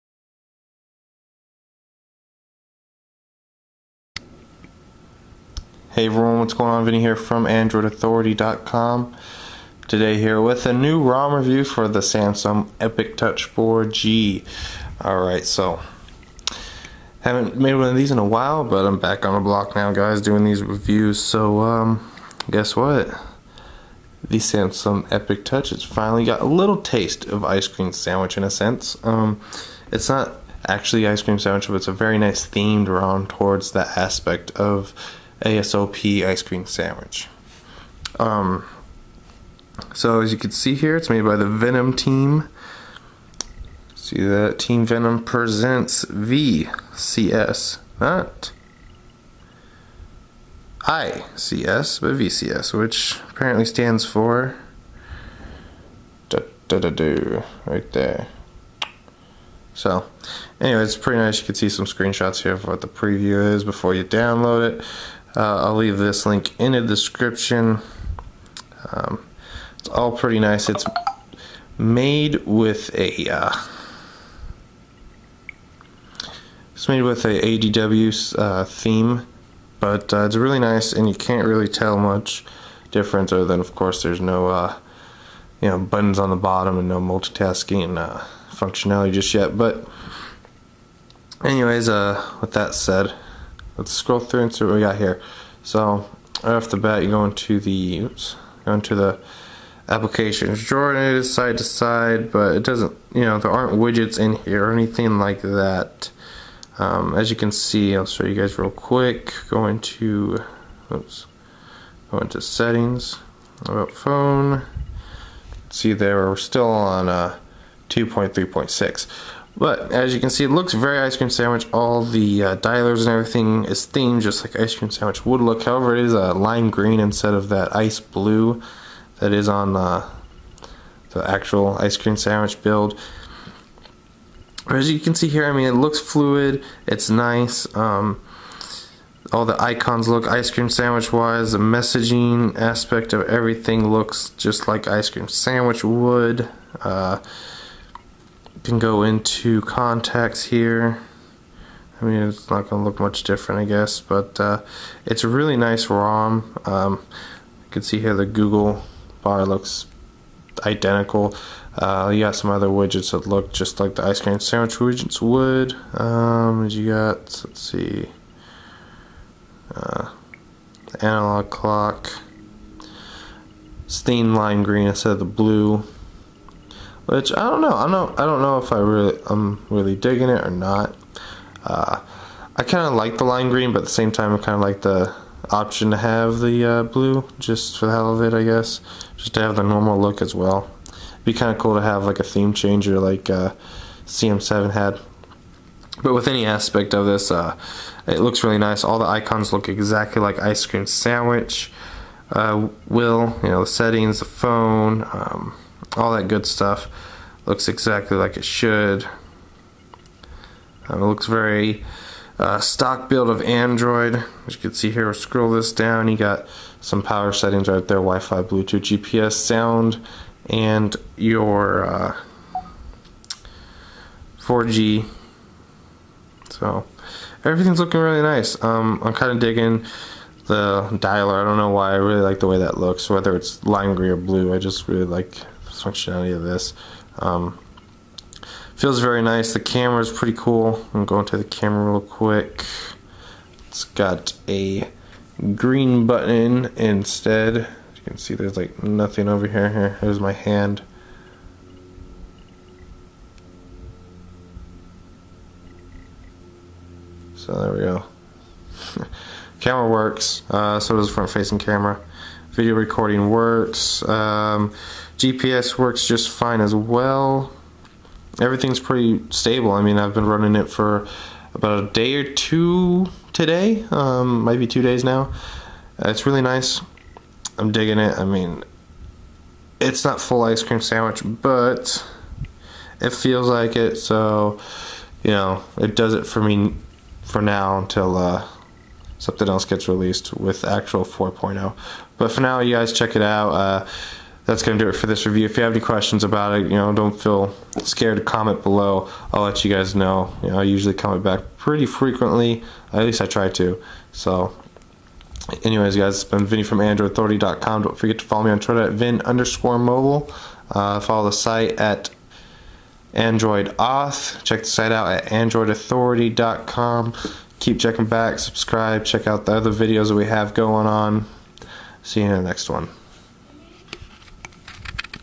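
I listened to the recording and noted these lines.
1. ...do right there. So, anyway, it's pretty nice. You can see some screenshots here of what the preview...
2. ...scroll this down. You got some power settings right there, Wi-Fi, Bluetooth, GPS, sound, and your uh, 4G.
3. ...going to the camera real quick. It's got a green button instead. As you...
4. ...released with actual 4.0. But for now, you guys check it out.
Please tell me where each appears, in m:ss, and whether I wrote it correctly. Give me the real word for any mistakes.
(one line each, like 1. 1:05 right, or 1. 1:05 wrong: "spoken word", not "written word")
1. 0:56 right
2. 3:35 right
3. 4:01 right
4. 4:49 right.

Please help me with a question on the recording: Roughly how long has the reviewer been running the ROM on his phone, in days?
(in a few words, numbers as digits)
2 days.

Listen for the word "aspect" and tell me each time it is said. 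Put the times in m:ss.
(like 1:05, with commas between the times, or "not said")
0:33, 2:22, 3:16.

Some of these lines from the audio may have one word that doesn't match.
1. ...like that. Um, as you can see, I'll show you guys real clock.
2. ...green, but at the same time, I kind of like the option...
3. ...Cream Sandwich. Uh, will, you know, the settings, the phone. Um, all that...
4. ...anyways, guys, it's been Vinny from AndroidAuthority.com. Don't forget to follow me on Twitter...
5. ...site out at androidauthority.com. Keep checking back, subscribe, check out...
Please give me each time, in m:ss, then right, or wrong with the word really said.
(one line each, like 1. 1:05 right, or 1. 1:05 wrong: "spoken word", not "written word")
1. 1:45 wrong: "quick", not "clock"
2. 3:03 right
3. 3:20 right
4. 5:05 right
5. 5:14 right.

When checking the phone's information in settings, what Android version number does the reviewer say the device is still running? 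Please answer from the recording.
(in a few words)
2.3.6.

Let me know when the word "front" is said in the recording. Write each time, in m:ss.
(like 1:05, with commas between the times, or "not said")
4:21.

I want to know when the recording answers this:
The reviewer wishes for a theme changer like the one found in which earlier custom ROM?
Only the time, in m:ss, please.
3:14.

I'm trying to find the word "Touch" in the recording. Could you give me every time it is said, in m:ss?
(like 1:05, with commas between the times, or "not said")
0:13, 0:25.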